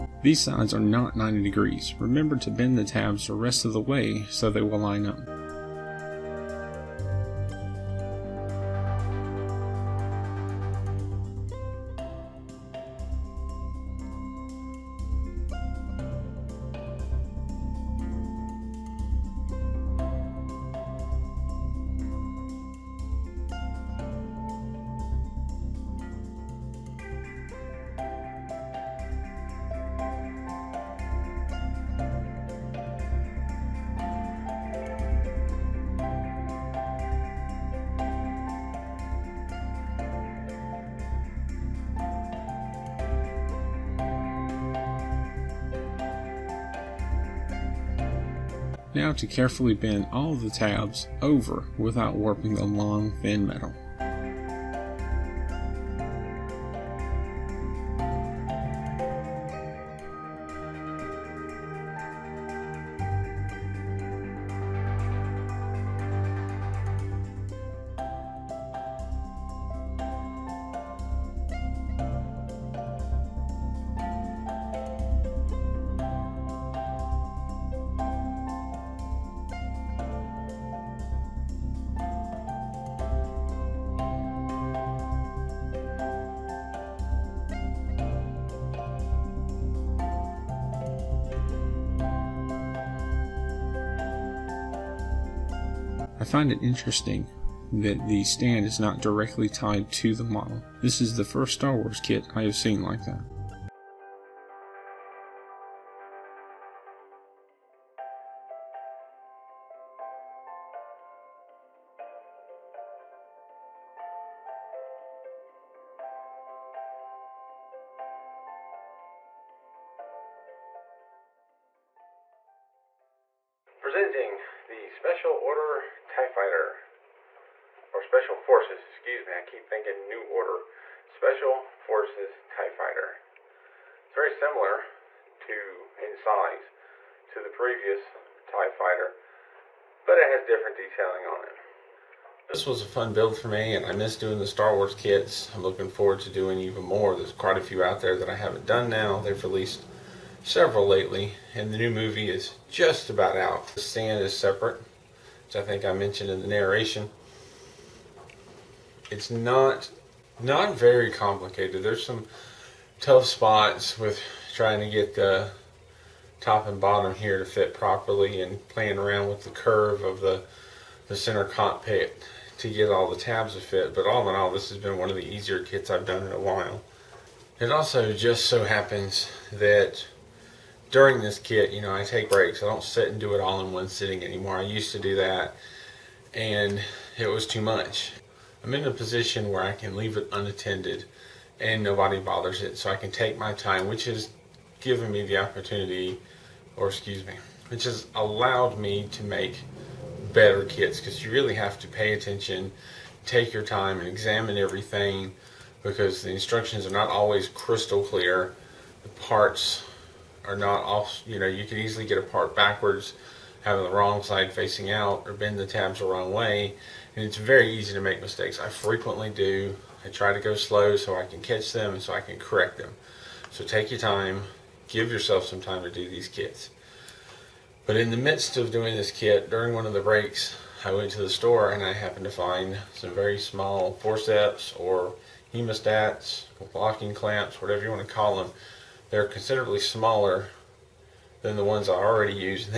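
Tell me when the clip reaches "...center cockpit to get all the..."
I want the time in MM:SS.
02:51.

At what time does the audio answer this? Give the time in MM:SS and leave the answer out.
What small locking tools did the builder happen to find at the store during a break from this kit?
03:55.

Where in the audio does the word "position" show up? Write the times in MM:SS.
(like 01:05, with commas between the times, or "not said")
03:08.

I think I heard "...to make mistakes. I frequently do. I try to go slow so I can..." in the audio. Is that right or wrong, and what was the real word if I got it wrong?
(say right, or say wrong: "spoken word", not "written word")
right.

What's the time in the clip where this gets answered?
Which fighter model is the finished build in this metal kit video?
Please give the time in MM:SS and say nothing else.
02:11.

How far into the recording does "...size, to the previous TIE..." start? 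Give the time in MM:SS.
02:16.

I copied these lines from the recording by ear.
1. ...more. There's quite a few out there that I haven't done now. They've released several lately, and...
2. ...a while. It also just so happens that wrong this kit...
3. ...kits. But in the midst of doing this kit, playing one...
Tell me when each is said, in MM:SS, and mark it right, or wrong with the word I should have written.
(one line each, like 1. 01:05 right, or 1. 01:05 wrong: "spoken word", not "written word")
1. 02:26 right
2. 02:56 wrong: "during", not "wrong"
3. 03:46 wrong: "during", not "playing".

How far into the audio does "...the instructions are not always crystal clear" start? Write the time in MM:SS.
03:26.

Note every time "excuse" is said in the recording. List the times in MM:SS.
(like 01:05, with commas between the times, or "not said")
02:08, 03:16.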